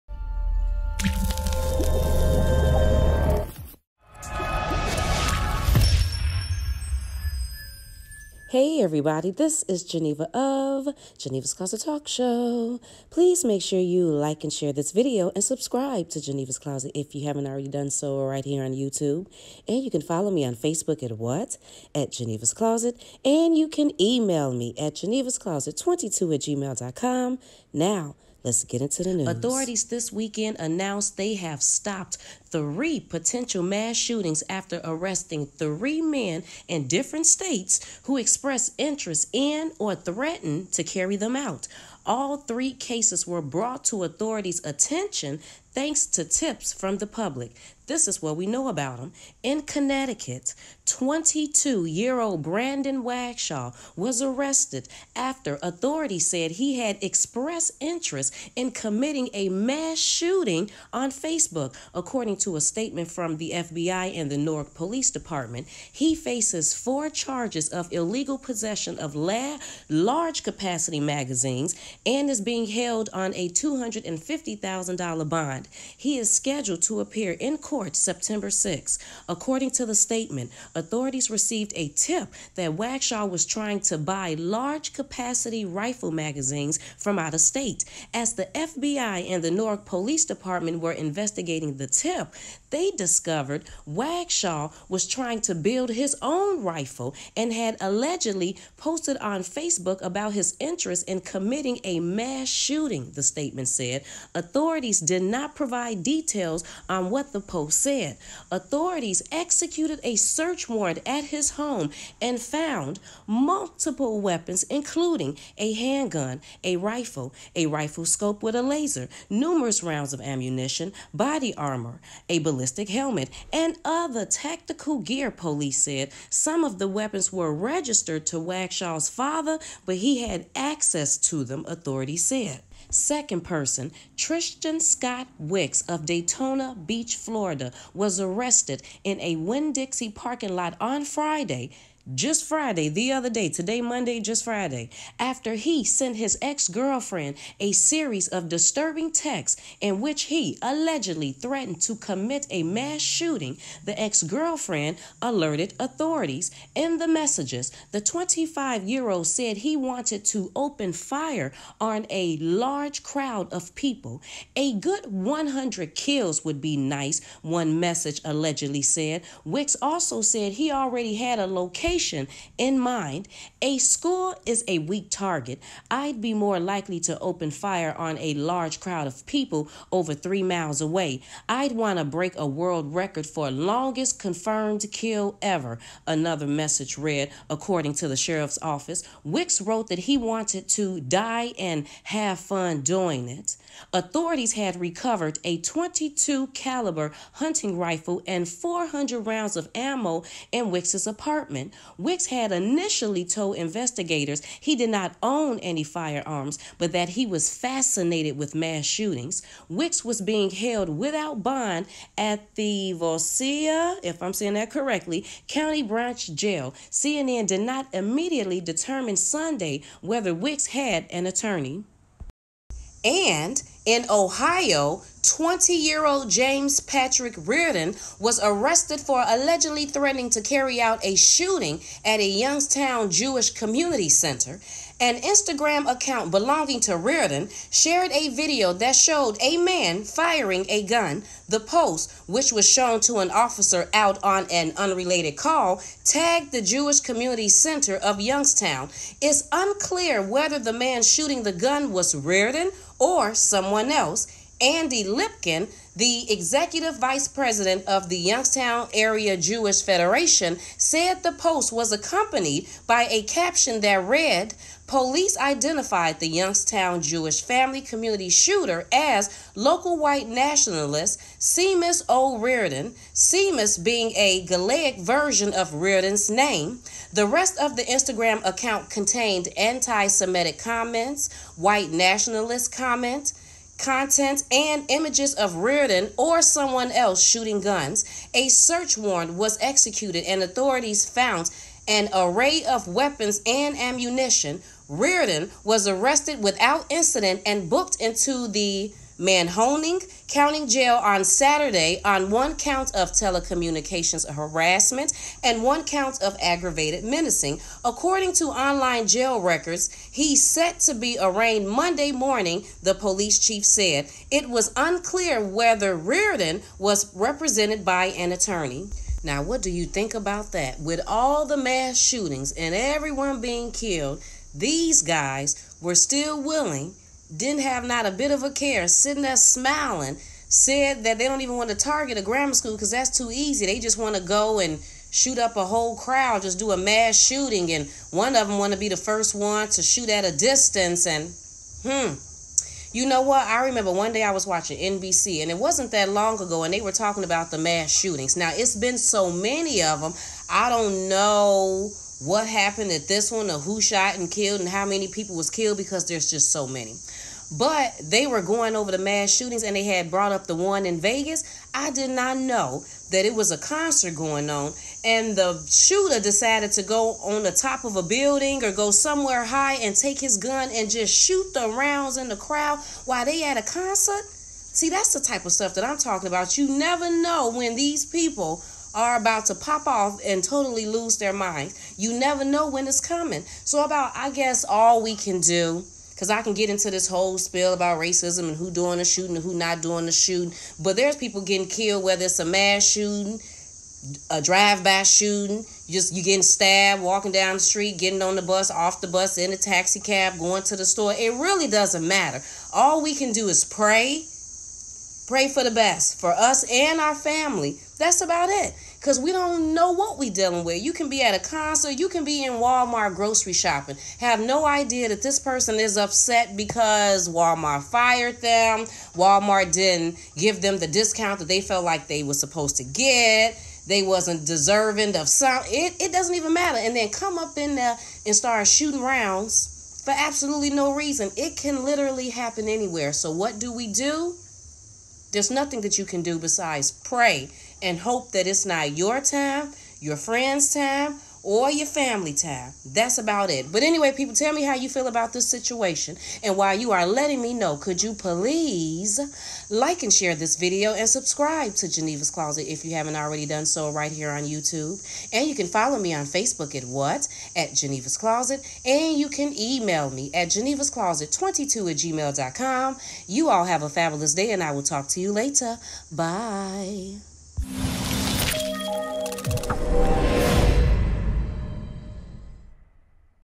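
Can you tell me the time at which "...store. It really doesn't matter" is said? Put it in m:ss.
6:40.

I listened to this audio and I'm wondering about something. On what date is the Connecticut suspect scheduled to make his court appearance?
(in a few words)
September 6.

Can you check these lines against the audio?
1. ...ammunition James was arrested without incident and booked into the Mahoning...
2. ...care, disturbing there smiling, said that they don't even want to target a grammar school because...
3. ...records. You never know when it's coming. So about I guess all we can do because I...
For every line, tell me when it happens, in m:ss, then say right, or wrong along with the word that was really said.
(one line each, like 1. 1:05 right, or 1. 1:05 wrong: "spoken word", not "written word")
1. 4:53 wrong: "Reardon", not "James"
2. 5:28 wrong: "sitting", not "disturbing"
3. 6:21 wrong: "minds", not "records".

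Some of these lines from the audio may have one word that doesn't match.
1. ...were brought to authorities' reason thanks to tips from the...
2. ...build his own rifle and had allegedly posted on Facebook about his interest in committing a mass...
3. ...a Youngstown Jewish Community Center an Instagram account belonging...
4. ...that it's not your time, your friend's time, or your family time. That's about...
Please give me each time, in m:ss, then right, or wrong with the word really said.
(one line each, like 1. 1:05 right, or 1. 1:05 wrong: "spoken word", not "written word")
1. 0:43 wrong: "attention", not "reason"
2. 1:35 right
3. 3:52 right
4. 7:18 right.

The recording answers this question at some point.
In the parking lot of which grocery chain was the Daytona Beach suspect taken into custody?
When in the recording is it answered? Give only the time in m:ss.
2:19.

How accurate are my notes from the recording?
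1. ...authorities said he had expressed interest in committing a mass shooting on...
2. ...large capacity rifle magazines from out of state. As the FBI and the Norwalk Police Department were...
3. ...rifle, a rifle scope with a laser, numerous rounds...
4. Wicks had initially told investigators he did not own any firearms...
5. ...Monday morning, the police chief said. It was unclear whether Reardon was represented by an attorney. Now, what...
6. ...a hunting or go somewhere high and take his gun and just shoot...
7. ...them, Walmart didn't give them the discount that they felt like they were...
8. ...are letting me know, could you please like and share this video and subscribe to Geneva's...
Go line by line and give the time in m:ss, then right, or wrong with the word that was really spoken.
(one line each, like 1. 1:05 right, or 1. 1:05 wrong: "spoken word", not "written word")
1. 0:55 right
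2. 1:24 right
3. 1:56 right
4. 3:21 right
5. 5:11 right
6. 6:07 wrong: "building", not "hunting"
7. 6:58 right
8. 7:26 right.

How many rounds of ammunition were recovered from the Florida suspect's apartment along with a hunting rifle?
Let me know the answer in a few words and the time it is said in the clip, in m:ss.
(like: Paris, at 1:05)
400, at 3:18.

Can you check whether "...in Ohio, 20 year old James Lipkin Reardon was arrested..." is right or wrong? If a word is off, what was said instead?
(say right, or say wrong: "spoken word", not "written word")
wrong: "Patrick", not "Lipkin".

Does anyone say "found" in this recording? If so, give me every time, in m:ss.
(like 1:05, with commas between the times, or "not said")
1:52, 4:51.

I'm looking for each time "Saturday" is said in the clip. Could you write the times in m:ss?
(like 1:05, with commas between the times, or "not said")
5:01.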